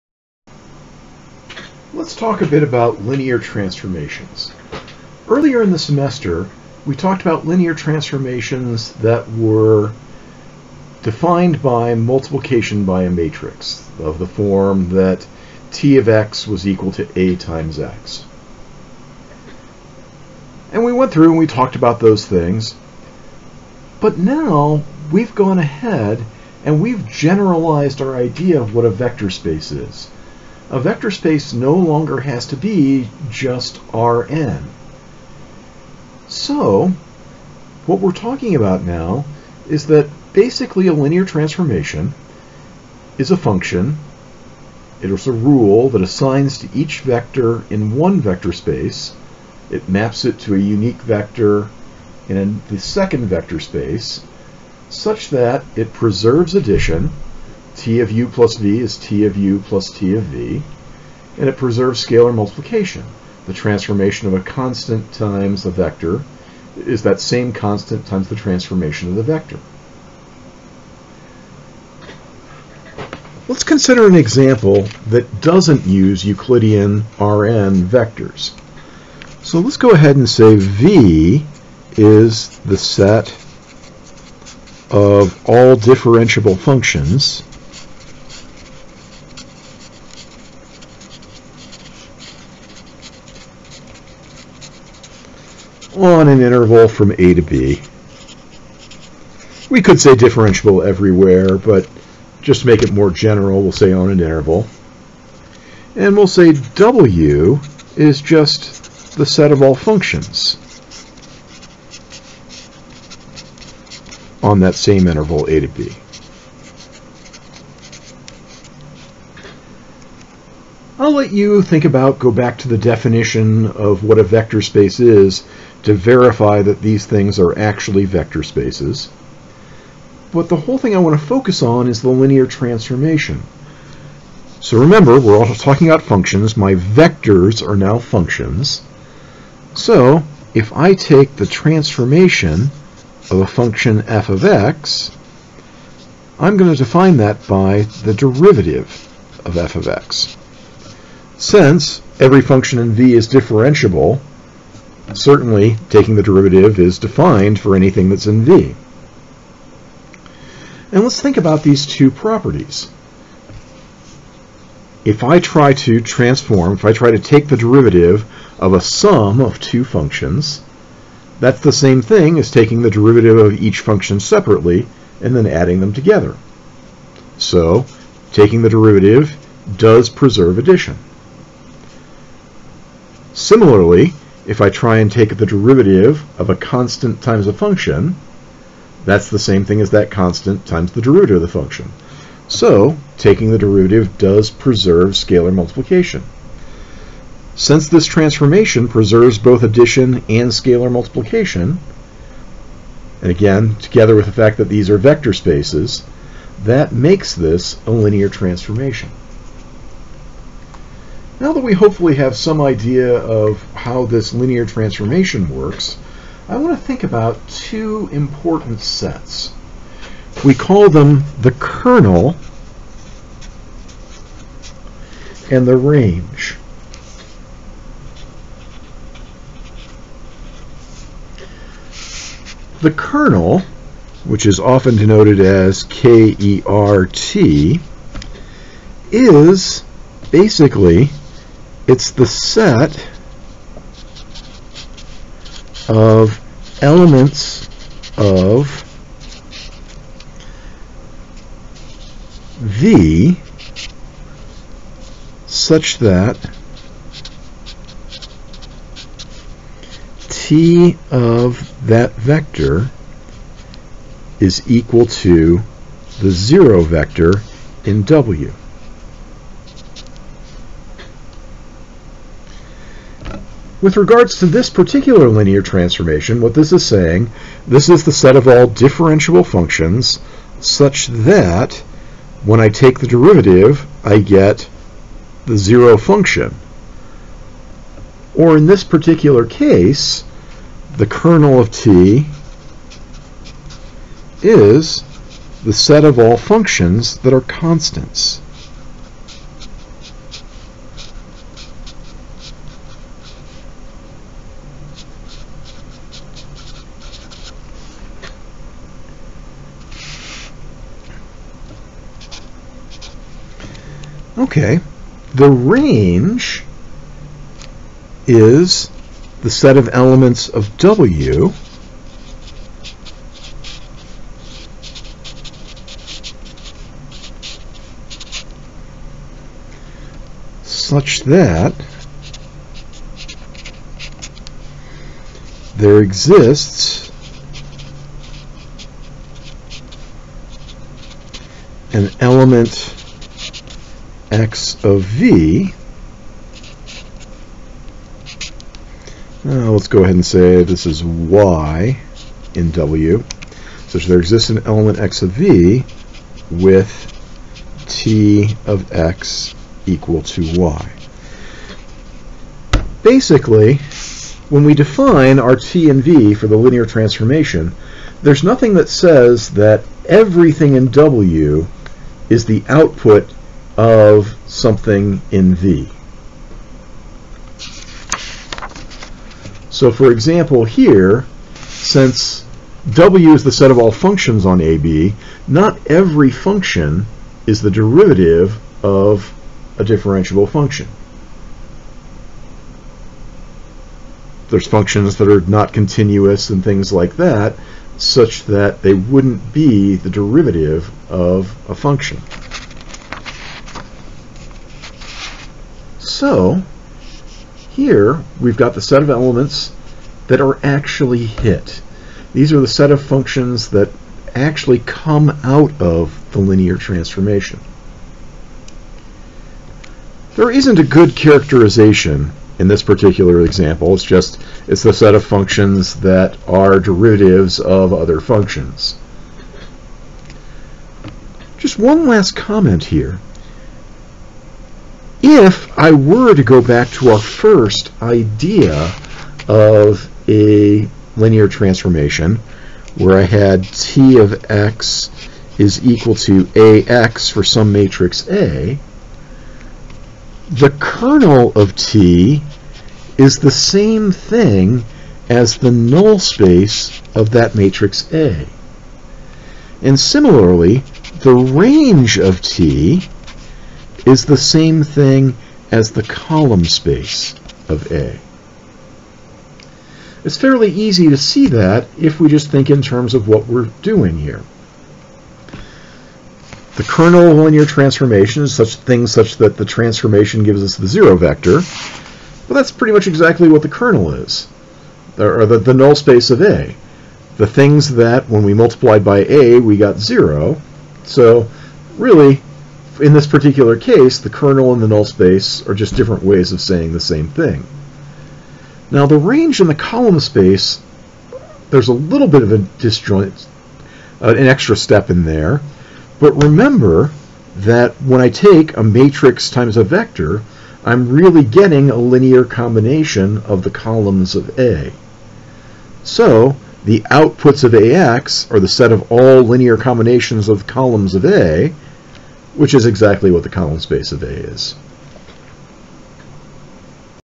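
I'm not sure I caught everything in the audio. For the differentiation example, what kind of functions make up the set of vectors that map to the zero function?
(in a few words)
constants.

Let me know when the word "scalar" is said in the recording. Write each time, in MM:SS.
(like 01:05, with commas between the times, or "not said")
01:02, 03:15, 03:20.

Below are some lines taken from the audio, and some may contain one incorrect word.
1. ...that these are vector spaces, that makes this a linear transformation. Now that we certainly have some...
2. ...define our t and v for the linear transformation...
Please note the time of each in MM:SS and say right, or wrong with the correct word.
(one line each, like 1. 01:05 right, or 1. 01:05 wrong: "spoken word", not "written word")
1. 03:24 wrong: "hopefully", not "certainly"
2. 06:04 right.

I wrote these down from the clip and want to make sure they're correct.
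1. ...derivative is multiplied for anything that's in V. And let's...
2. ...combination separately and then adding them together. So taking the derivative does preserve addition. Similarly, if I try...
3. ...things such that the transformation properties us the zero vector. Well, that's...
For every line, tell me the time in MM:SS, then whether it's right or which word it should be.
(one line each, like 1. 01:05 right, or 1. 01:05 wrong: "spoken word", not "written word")
1. 02:36 wrong: "defined", not "multiplied"
2. 02:53 wrong: "function", not "combination"
3. 07:58 wrong: "gives", not "properties".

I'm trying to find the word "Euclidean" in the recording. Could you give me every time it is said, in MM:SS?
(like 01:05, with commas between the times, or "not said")
01:16.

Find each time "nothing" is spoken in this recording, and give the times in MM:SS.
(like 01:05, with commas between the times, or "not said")
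06:08.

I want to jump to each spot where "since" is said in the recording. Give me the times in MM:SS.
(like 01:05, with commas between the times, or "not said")
02:31, 03:17, 06:21.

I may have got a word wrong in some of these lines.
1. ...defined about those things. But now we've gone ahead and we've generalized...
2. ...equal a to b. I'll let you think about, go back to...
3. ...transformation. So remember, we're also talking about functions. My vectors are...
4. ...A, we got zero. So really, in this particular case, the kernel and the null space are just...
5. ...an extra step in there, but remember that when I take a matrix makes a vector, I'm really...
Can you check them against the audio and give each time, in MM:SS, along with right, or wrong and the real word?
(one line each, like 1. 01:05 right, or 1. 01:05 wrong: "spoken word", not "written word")
1. 00:21 wrong: "talked", not "defined"
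2. 01:55 wrong: "interval", not "equal"
3. 02:12 right
4. 08:09 right
5. 08:24 wrong: "times", not "makes".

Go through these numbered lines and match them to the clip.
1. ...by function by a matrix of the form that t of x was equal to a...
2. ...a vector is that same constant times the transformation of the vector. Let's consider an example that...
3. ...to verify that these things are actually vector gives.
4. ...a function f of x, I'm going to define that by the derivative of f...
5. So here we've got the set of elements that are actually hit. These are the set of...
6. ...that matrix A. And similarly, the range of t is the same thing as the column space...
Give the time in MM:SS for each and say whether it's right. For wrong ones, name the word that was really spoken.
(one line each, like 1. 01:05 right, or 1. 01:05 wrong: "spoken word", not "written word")
1. 00:11 wrong: "multiplication", not "function"
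2. 01:05 right
3. 02:05 wrong: "spaces", not "gives"
4. 02:23 right
5. 06:46 right
6. 07:37 right.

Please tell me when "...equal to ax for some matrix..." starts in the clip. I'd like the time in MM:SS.
07:25.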